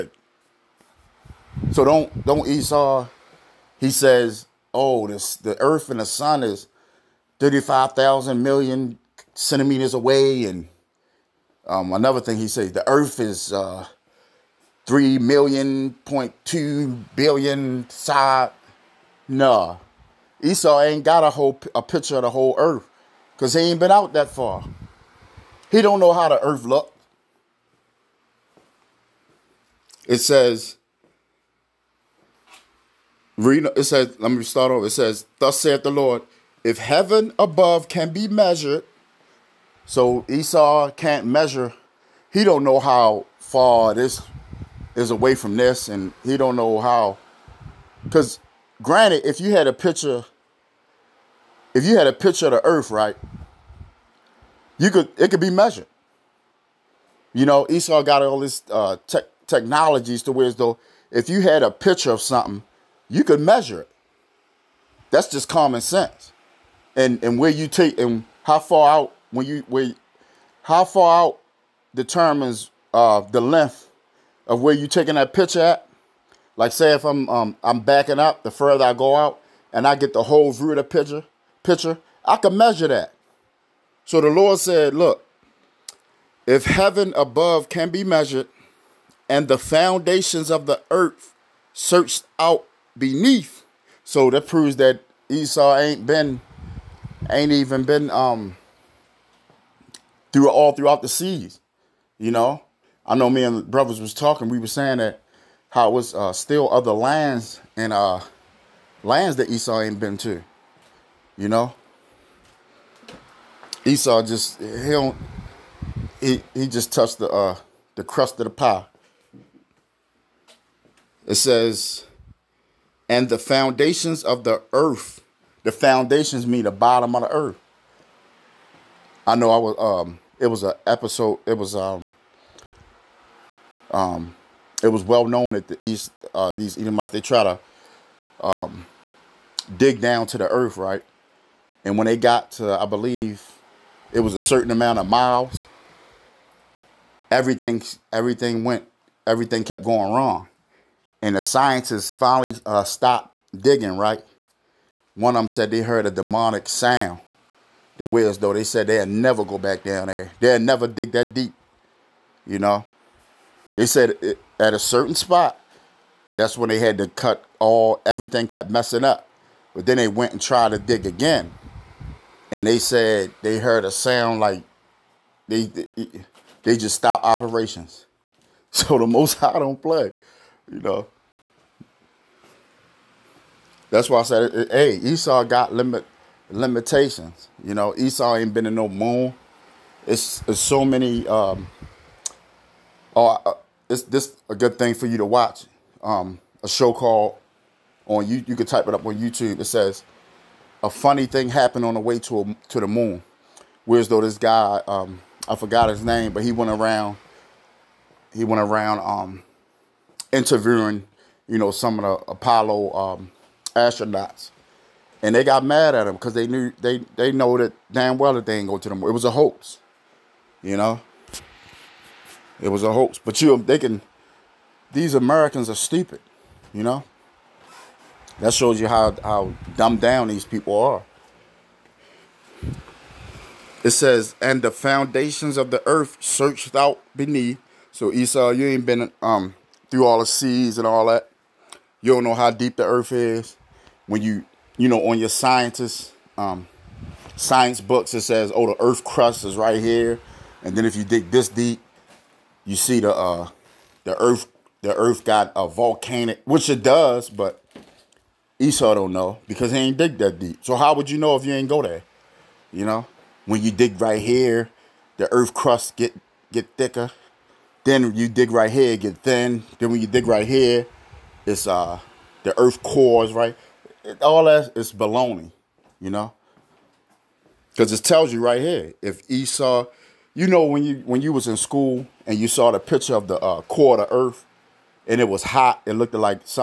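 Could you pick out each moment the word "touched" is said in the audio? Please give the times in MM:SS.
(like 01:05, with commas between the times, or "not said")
01:56.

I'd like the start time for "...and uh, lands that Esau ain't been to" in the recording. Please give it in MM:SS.
01:47.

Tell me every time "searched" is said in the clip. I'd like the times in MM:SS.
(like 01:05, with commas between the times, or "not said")
01:31, 03:56.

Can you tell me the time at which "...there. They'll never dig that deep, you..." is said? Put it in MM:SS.
02:40.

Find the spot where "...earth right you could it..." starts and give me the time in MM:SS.
00:52.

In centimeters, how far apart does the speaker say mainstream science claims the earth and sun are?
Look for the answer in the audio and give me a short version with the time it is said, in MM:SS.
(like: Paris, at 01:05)
35,000 million centimeters, at 00:07.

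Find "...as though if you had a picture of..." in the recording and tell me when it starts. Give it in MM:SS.
01:00.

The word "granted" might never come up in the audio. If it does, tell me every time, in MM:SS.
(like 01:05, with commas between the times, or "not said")
00:48.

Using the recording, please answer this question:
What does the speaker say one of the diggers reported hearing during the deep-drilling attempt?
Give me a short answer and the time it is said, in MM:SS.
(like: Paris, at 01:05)
a demonic sound, at 02:36.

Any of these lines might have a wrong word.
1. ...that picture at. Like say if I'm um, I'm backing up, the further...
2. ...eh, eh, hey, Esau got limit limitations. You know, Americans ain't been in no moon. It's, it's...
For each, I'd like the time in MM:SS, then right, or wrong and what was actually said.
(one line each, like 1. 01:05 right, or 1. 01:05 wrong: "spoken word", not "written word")
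1. 01:15 right
2. 03:04 wrong: "Esau", not "Americans".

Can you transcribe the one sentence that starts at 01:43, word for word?
I know me and brothers was talking.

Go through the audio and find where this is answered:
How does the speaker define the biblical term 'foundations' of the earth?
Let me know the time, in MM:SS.
02:06.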